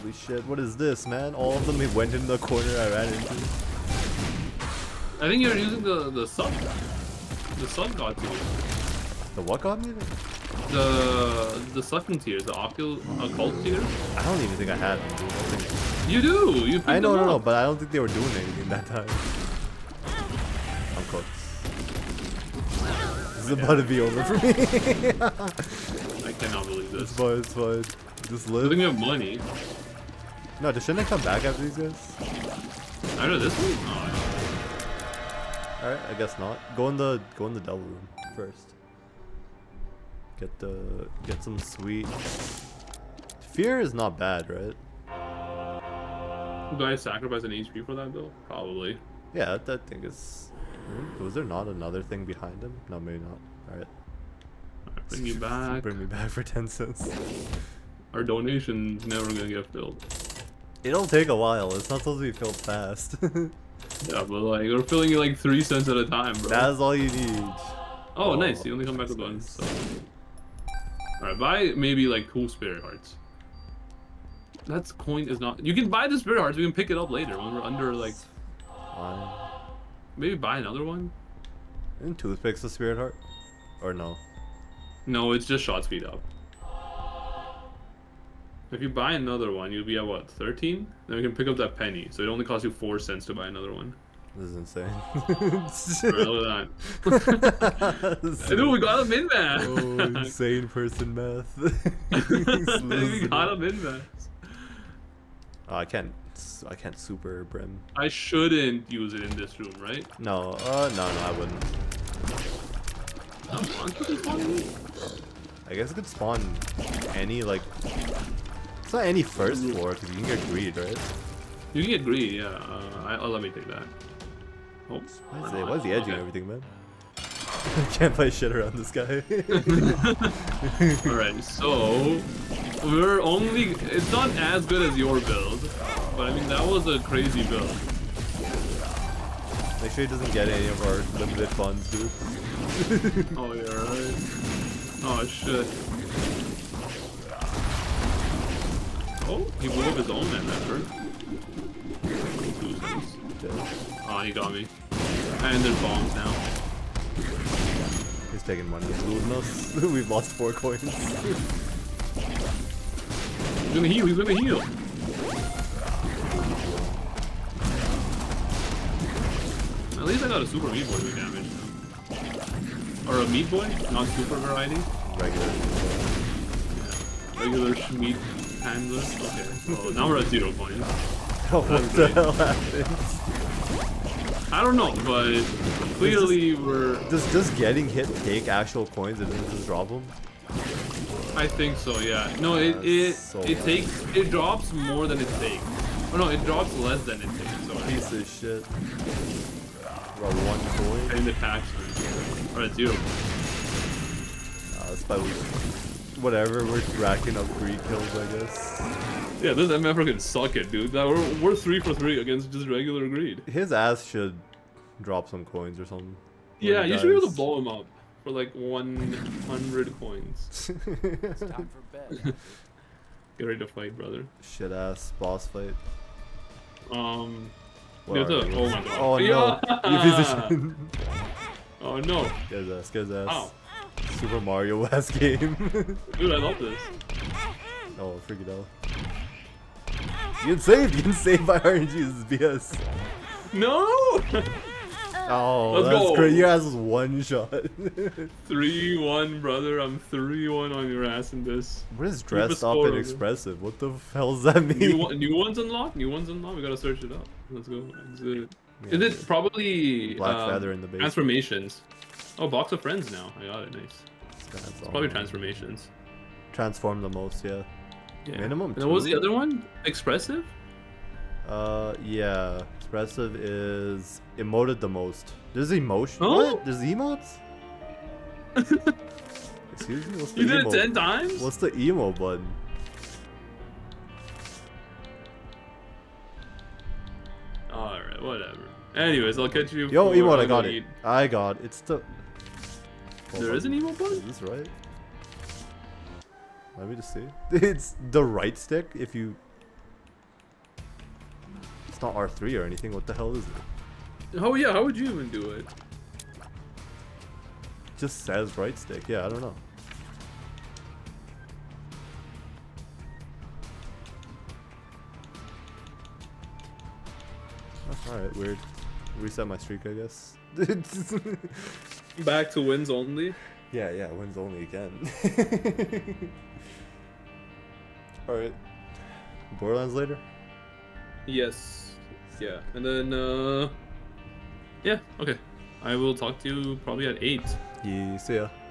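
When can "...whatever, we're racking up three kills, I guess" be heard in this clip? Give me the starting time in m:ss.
3:26.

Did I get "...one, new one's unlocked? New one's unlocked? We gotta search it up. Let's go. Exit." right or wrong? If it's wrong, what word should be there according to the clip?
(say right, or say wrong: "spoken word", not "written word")
right.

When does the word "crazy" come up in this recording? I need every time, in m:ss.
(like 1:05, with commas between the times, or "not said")
2:16, 4:06.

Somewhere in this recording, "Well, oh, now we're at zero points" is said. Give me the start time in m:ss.
2:59.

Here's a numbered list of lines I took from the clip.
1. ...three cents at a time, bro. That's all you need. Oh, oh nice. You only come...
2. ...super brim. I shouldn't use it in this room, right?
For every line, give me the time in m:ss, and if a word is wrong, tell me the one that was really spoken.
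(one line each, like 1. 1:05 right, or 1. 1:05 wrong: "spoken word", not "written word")
1. 1:05 right
2. 1:46 right.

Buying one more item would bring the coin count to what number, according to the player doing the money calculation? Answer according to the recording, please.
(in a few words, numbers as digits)
13.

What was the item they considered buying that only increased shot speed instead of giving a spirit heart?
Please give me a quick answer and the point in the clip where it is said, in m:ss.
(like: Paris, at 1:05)
Toothpicks, at 1:22.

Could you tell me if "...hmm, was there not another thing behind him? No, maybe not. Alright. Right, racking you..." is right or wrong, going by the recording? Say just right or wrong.
wrong.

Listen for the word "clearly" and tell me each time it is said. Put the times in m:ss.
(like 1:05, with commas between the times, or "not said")
3:05.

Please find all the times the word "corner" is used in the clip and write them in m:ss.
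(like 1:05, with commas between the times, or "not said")
0:02.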